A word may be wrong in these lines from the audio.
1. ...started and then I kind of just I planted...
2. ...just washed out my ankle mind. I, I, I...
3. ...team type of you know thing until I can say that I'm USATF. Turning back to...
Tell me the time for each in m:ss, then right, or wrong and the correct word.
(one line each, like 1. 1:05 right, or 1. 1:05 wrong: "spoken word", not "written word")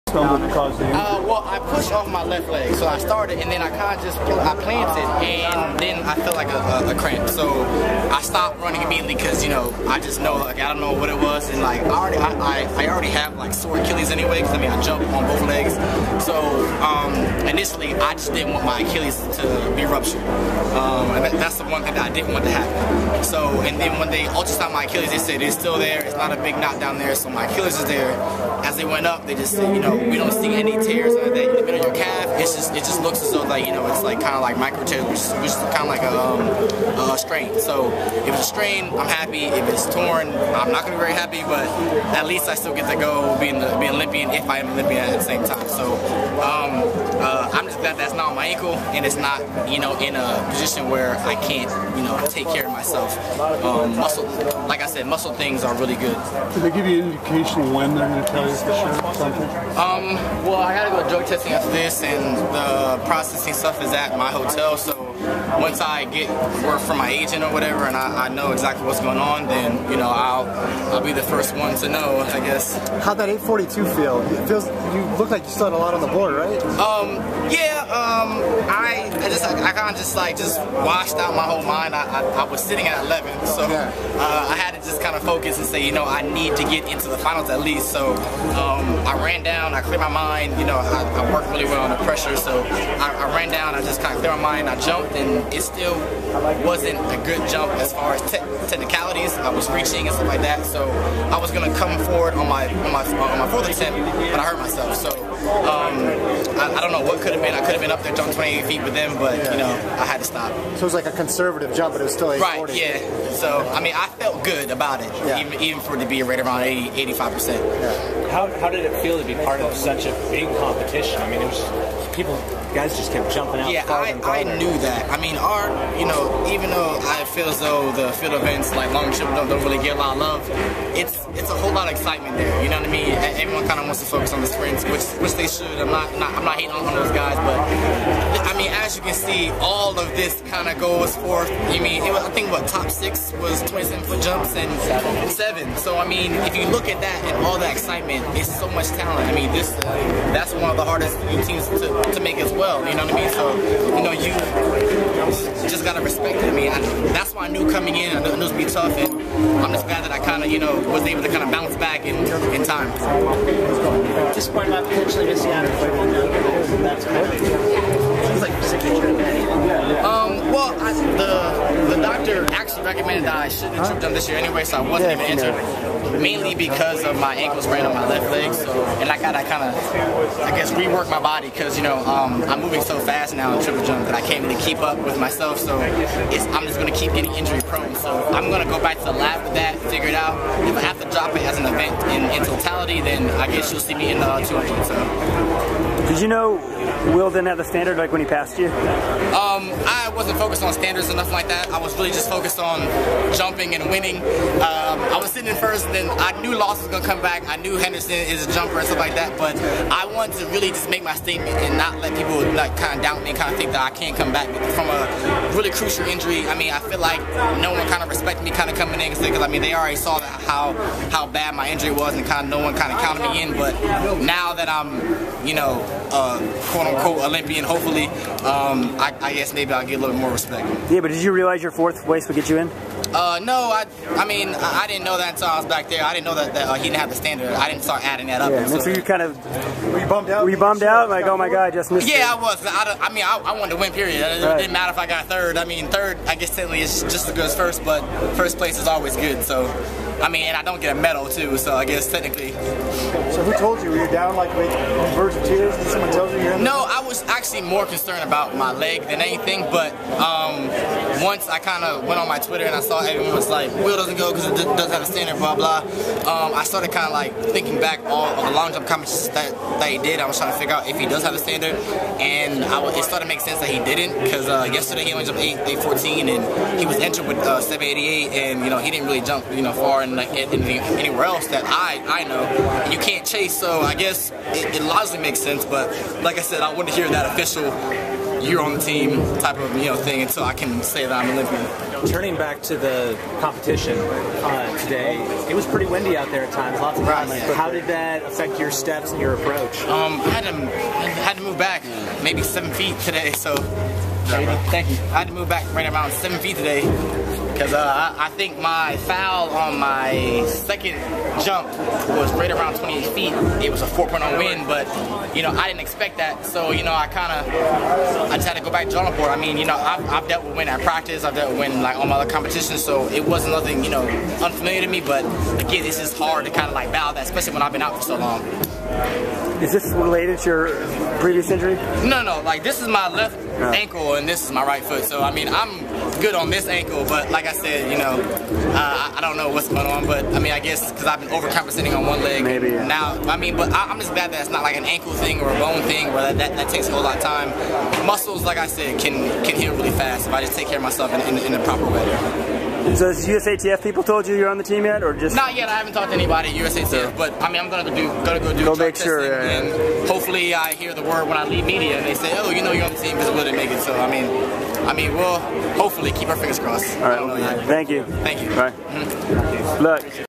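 1. 0:02 right
2. 1:20 wrong: "whole", not "ankle"
3. 4:48 wrong: "Olympian", not "USATF".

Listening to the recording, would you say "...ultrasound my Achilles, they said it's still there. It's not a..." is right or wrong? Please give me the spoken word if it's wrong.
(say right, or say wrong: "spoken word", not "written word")
right.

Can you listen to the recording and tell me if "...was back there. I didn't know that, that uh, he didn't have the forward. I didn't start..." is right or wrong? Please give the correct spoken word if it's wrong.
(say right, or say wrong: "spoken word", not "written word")
wrong: "standard", not "forward".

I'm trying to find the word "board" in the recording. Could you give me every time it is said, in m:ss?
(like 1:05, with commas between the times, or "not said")
1:16, 5:19.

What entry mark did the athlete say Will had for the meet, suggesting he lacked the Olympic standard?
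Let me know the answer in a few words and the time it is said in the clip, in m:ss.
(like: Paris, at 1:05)
788, at 4:37.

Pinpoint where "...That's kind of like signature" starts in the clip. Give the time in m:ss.
2:46.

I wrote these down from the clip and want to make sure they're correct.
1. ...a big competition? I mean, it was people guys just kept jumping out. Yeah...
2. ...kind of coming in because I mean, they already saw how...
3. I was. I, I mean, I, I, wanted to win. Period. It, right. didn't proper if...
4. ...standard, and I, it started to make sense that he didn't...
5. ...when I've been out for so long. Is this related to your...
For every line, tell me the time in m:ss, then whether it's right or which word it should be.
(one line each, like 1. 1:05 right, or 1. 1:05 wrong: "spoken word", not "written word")
1. 2:00 right
2. 3:38 right
3. 4:02 wrong: "matter", not "proper"
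4. 4:31 right
5. 5:27 right.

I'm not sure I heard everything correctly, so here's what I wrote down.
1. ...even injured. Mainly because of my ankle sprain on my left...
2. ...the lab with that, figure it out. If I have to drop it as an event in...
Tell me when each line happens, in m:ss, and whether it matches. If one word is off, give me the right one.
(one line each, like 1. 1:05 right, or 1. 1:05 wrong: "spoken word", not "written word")
1. 2:55 right
2. 3:09 right.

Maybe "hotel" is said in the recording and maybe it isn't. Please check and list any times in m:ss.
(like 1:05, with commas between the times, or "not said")
1:04.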